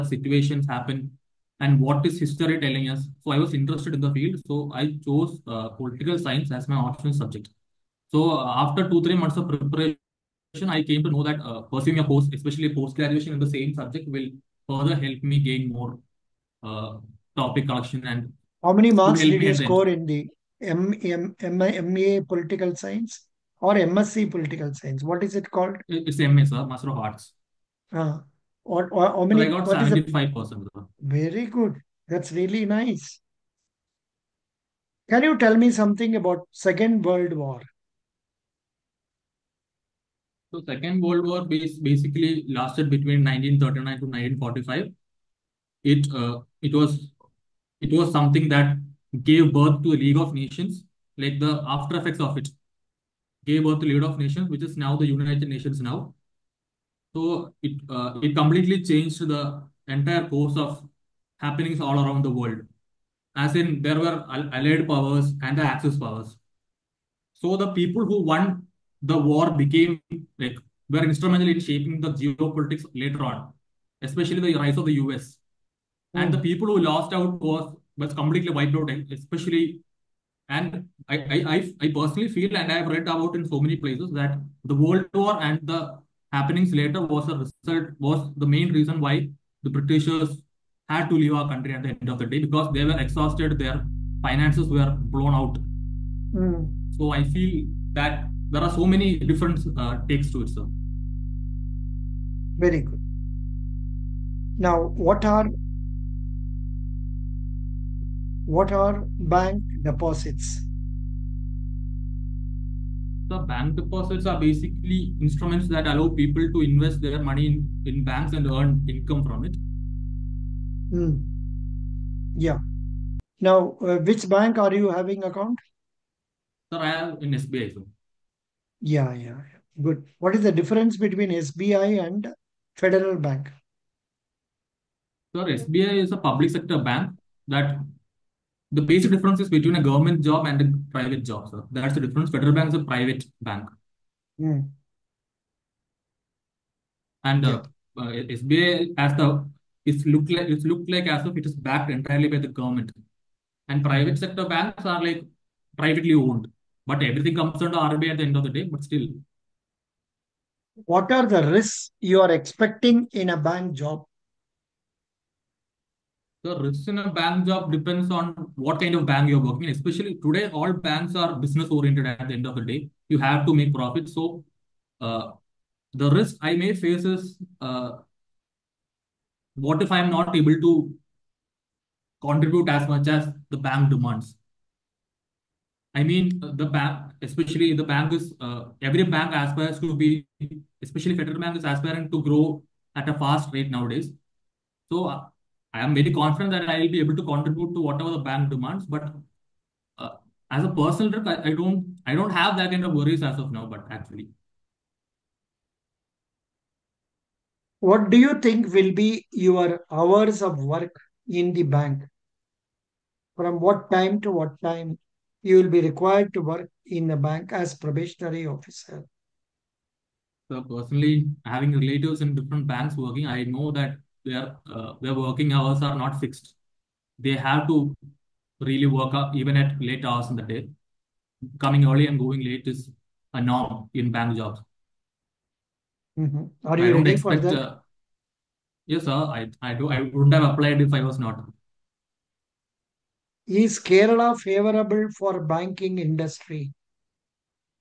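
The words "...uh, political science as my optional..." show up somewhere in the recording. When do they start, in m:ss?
0:05.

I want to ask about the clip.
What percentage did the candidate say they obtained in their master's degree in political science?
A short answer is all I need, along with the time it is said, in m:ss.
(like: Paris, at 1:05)
75%, at 0:29.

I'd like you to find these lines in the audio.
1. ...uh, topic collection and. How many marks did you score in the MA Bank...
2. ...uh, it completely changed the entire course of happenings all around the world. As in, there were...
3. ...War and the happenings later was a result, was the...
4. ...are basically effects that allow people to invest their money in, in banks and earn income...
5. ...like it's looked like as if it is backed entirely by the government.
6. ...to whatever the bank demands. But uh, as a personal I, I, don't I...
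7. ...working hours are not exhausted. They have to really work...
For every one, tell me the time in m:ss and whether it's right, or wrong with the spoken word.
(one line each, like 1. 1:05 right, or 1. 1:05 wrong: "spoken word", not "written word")
1. 0:16 wrong: "Political", not "Bank"
2. 0:57 right
3. 1:25 right
4. 1:54 wrong: "instruments", not "effects"
5. 2:30 right
6. 3:17 right
7. 3:45 wrong: "fixed", not "exhausted".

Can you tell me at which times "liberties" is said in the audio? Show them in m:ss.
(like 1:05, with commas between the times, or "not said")
not said.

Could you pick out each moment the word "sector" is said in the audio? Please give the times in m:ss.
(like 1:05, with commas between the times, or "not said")
2:16, 2:34.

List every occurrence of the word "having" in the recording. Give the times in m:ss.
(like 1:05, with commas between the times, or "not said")
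2:04, 3:41.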